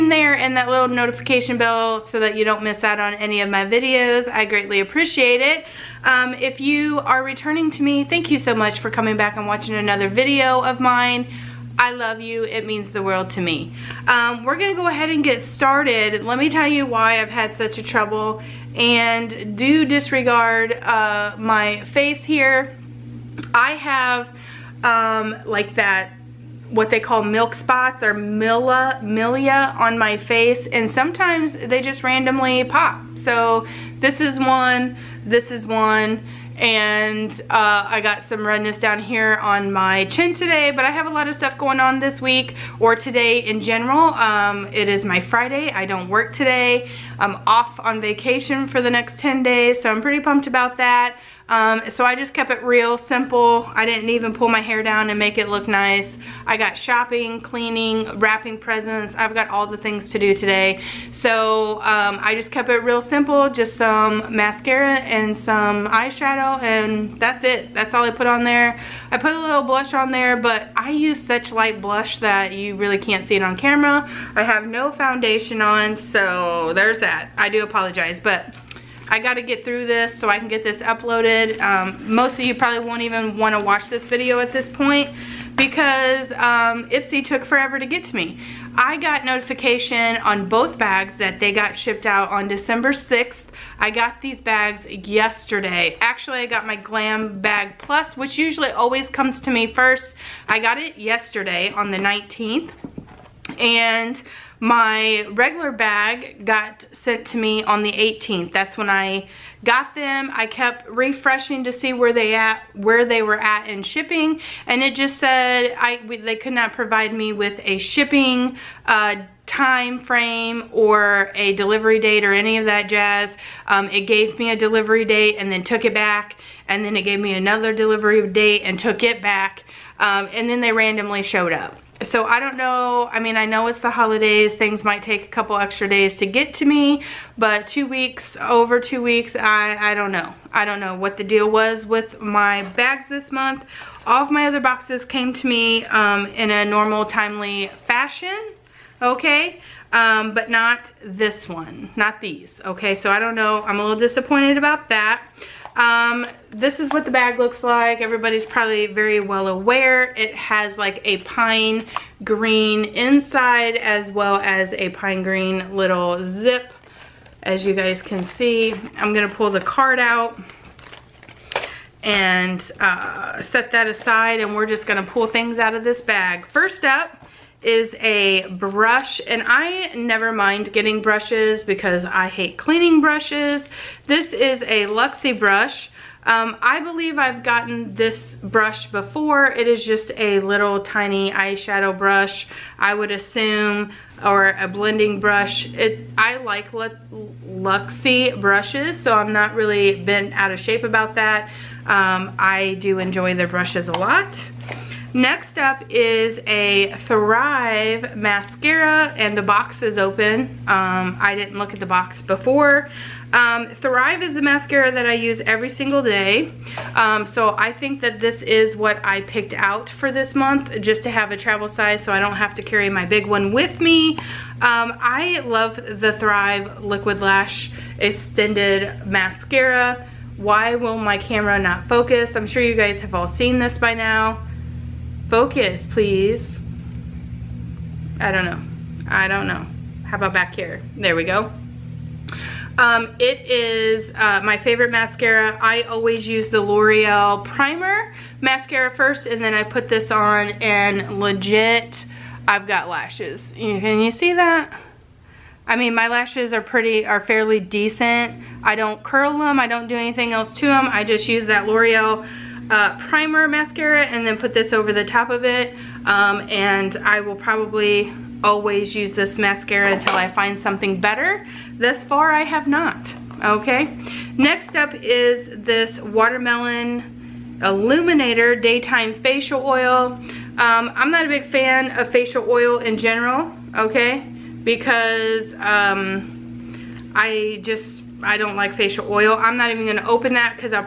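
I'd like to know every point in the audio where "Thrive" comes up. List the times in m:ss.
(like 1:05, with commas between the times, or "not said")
3:27, 3:33, 3:46.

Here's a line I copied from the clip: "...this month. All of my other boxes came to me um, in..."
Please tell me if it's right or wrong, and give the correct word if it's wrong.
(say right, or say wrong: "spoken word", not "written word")
right.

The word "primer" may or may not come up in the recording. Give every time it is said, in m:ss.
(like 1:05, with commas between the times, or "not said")
4:07, 4:23.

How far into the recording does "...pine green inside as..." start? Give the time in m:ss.
2:41.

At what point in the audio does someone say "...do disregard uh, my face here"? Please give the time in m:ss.
0:19.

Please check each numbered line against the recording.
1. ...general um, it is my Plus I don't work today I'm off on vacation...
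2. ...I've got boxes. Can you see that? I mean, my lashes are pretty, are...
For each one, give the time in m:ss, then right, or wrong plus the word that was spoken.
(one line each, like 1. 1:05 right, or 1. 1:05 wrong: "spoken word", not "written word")
1. 0:43 wrong: "Friday", not "Plus"
2. 4:12 wrong: "lashes", not "boxes".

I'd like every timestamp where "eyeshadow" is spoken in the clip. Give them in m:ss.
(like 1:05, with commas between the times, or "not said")
1:05, 3:11.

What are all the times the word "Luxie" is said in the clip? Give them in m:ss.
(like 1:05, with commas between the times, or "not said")
3:04, 3:16.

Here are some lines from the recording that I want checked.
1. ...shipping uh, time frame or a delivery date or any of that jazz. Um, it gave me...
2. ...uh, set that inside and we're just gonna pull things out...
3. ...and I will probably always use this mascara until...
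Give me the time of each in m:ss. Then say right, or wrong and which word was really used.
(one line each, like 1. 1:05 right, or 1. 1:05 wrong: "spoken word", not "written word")
1. 1:57 right
2. 2:52 wrong: "aside", not "inside"
3. 4:26 right.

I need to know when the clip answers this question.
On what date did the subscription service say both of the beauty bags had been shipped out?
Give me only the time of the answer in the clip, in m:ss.
1:32.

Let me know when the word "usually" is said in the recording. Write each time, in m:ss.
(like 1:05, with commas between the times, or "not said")
1:38.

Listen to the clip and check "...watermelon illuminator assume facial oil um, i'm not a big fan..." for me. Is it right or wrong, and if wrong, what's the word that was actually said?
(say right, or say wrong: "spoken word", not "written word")
wrong: "daytime", not "assume".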